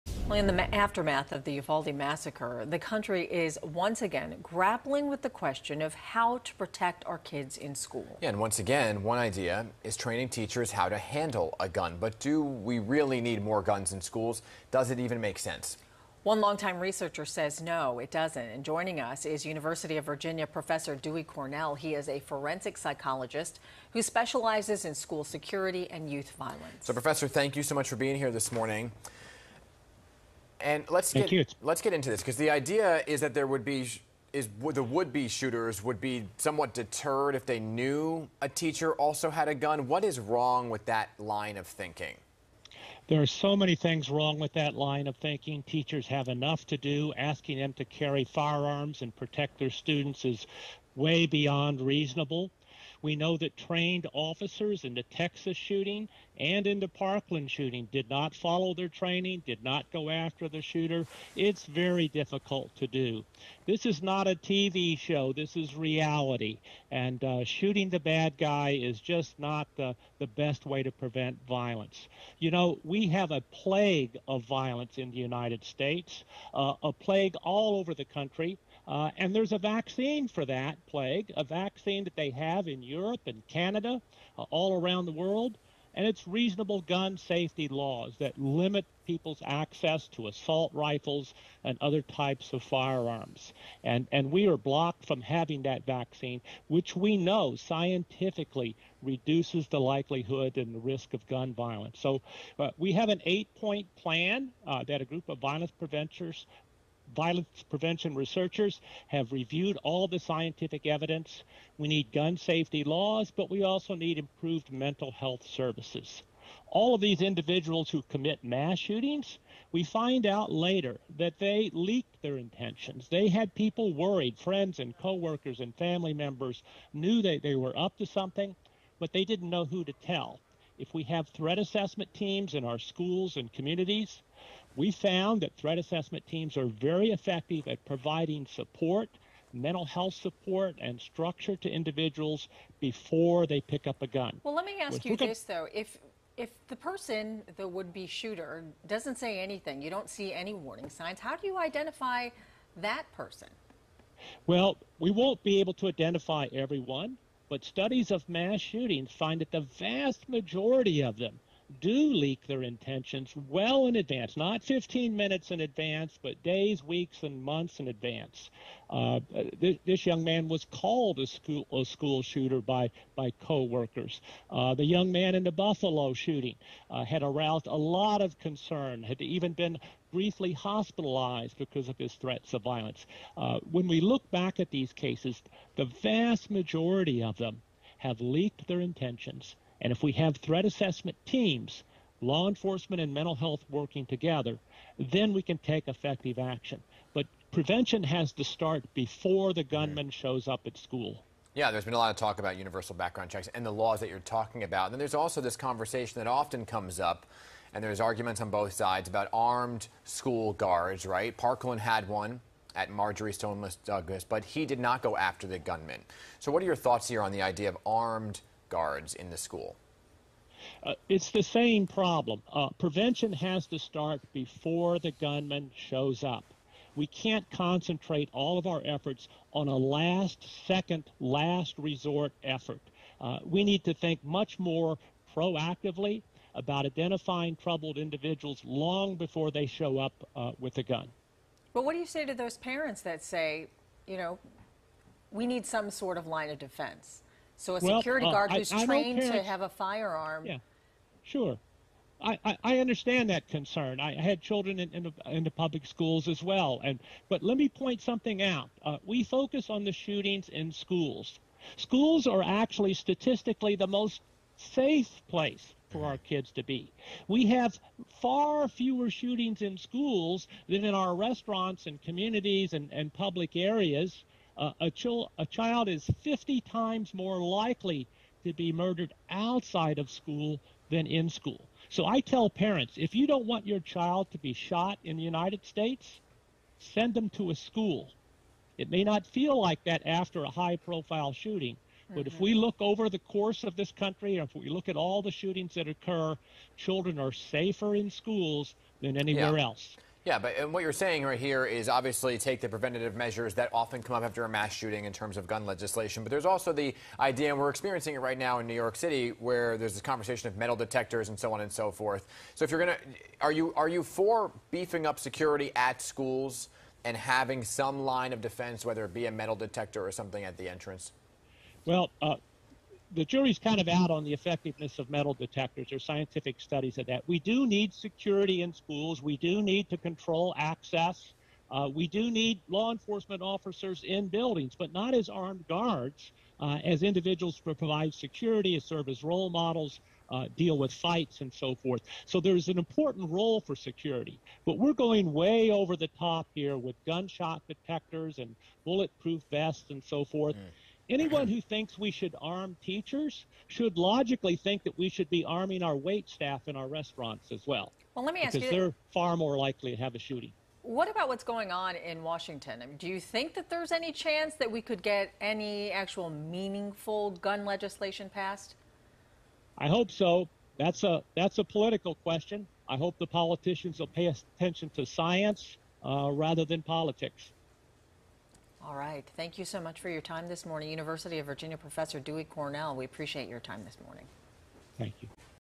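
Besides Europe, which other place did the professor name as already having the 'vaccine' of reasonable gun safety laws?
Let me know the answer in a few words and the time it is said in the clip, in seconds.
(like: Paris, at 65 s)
Canada, at 83 s.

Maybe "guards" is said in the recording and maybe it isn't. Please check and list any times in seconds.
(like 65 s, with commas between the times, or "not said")
210 s, 218 s, 248 s, 335 s.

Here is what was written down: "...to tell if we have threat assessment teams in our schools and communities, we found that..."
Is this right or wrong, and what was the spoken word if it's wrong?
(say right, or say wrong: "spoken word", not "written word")
right.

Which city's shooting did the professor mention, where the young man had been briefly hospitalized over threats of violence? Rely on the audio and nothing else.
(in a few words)
Buffalo.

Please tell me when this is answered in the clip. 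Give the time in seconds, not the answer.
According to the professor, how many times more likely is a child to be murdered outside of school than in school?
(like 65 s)
276 s.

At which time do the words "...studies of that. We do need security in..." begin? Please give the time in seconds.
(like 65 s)
326 s.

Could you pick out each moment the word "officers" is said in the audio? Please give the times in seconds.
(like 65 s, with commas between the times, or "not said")
54 s, 333 s.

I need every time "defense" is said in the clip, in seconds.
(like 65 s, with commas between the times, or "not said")
246 s, 318 s.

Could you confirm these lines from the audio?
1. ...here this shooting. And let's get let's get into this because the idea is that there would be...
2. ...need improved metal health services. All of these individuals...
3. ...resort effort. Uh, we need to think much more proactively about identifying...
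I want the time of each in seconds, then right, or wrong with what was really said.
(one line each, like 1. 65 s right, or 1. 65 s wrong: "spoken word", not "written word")
1. 28 s wrong: "morning", not "shooting"
2. 113 s wrong: "mental", not "metal"
3. 231 s right.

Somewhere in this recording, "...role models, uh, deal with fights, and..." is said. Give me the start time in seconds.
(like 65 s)
339 s.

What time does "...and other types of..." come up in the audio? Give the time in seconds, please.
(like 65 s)
91 s.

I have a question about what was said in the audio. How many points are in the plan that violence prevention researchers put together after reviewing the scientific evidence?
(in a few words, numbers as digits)
8.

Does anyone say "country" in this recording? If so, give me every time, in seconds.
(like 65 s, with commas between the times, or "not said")
2 s, 78 s, 293 s.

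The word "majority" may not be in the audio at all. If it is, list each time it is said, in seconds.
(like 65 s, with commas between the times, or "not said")
160 s, 186 s.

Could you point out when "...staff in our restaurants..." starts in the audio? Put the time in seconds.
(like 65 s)
356 s.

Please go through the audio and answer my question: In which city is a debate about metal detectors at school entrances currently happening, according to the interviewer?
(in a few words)
New York City.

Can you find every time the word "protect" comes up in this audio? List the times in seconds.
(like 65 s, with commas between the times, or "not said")
6 s, 49 s.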